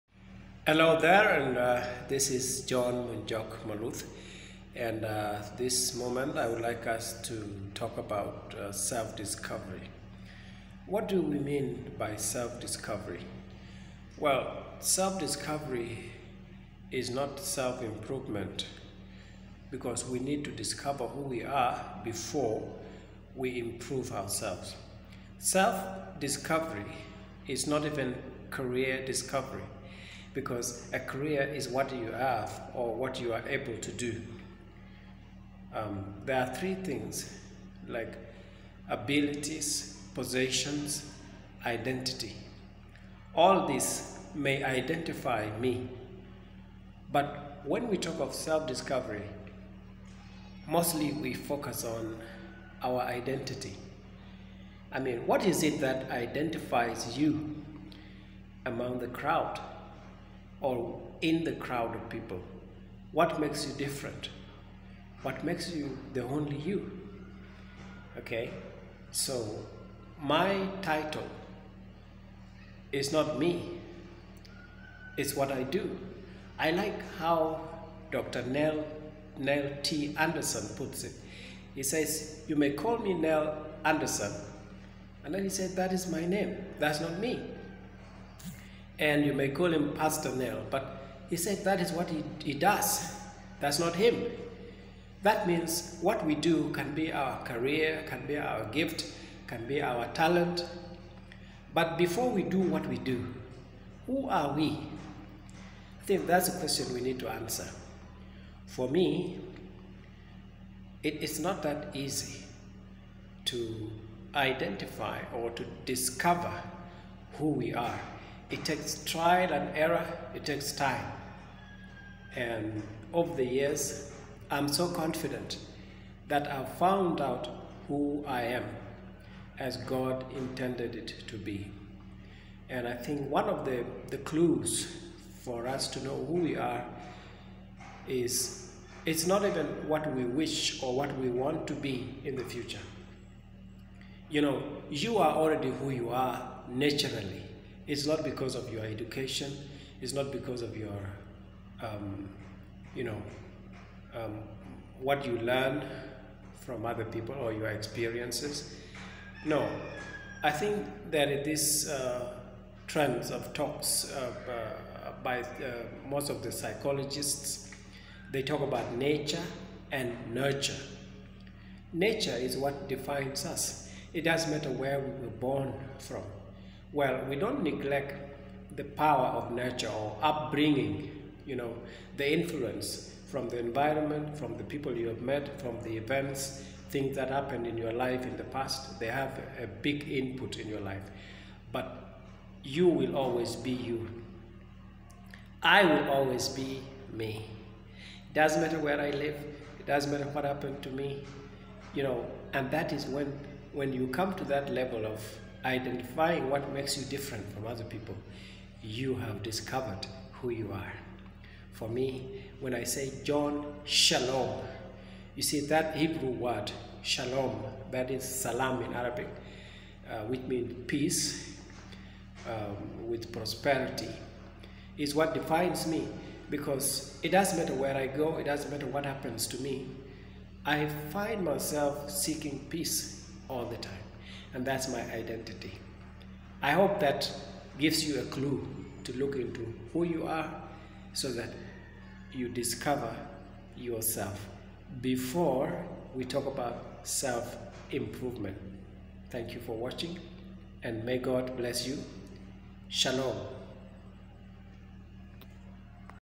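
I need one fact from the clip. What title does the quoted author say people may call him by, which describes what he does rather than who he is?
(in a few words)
Pastor Neil.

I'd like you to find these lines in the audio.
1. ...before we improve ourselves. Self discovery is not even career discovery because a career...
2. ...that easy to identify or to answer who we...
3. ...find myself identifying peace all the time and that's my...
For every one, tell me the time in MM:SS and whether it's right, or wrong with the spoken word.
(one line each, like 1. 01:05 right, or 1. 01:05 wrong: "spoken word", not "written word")
1. 00:22 right
2. 01:51 wrong: "discover", not "answer"
3. 03:51 wrong: "seeking", not "identifying".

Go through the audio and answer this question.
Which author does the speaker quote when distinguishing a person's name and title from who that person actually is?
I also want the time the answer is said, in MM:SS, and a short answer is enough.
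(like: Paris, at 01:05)
Neil T. Anderson, at 01:19.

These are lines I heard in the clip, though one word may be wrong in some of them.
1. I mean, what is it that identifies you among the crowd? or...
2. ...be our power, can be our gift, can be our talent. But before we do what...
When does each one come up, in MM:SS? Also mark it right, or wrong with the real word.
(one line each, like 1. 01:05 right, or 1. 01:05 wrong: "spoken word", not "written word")
1. 00:54 right
2. 01:36 wrong: "career", not "power".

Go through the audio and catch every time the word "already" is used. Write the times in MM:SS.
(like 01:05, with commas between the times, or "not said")
02:25.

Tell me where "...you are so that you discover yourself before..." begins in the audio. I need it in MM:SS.
04:00.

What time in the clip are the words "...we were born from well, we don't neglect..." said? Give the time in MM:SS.
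02:54.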